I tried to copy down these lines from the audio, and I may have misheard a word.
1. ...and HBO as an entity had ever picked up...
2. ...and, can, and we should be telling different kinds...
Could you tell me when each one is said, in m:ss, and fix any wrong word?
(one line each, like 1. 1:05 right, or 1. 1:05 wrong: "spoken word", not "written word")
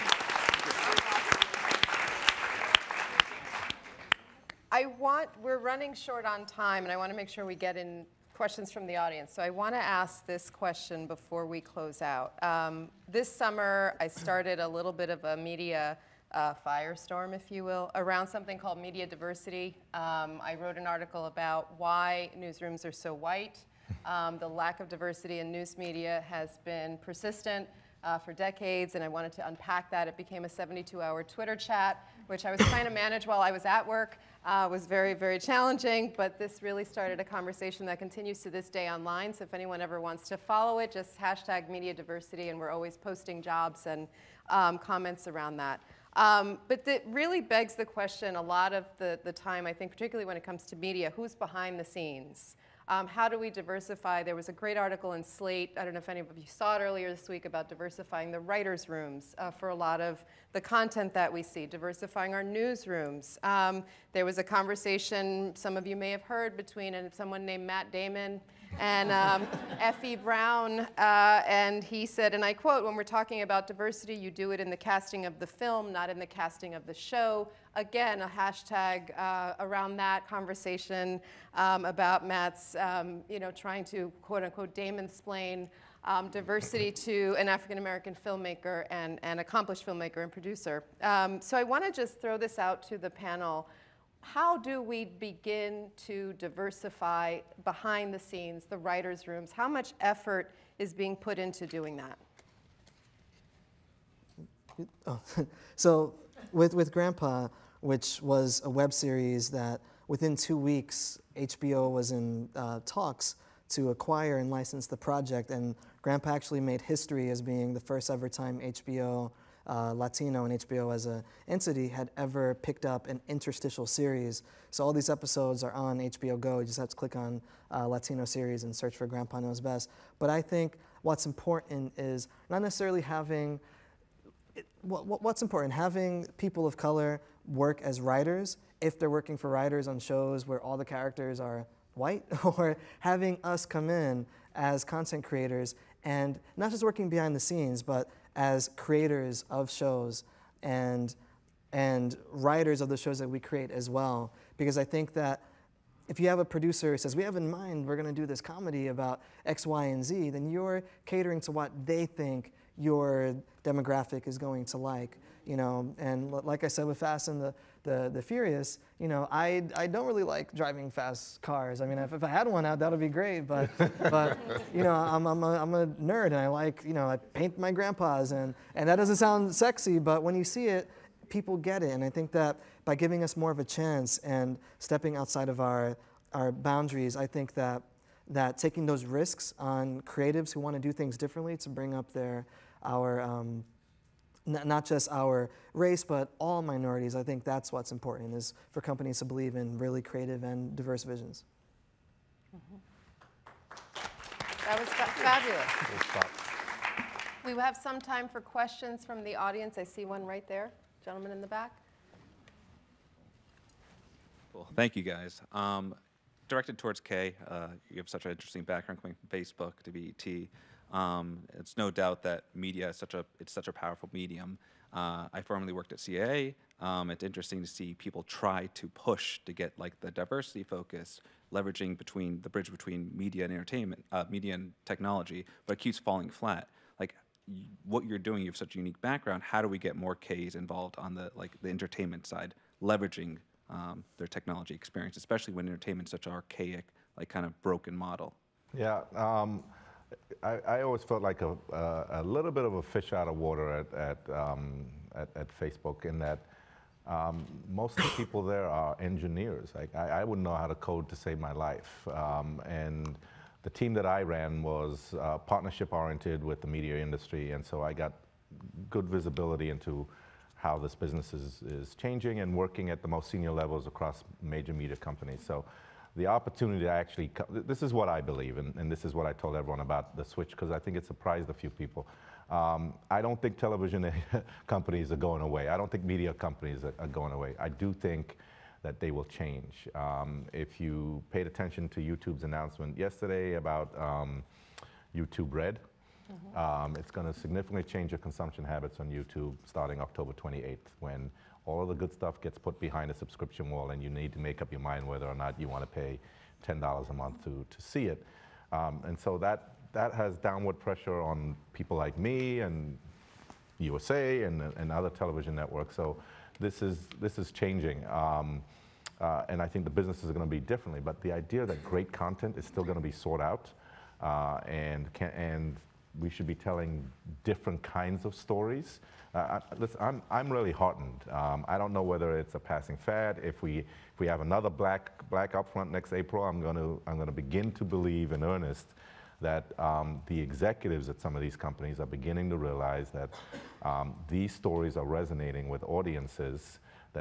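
1. 2:00 right
2. 5:24 right.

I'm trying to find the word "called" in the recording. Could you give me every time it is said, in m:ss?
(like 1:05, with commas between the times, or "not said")
0:18.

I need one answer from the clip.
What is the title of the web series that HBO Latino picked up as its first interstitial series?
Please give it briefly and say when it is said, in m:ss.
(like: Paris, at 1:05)
Grandpa Knows Best, at 2:09.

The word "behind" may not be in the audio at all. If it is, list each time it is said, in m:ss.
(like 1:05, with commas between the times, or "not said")
0:51, 1:37, 2:27, 5:02.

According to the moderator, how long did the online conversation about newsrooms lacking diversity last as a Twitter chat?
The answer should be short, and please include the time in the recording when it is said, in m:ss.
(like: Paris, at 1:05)
72 hours, at 0:30.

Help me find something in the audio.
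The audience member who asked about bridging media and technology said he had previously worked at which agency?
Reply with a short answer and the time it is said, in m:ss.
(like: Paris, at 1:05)
CAA, at 3:45.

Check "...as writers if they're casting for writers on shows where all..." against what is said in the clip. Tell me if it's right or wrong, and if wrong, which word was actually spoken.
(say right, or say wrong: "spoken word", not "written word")
wrong: "working", not "casting".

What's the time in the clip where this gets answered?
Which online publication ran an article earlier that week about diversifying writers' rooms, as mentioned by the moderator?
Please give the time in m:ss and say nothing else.
0:55.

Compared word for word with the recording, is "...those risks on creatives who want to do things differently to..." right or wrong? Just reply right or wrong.
right.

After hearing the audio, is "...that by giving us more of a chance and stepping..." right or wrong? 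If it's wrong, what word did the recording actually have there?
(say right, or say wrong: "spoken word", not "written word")
right.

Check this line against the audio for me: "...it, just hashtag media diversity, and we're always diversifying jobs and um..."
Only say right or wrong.
wrong.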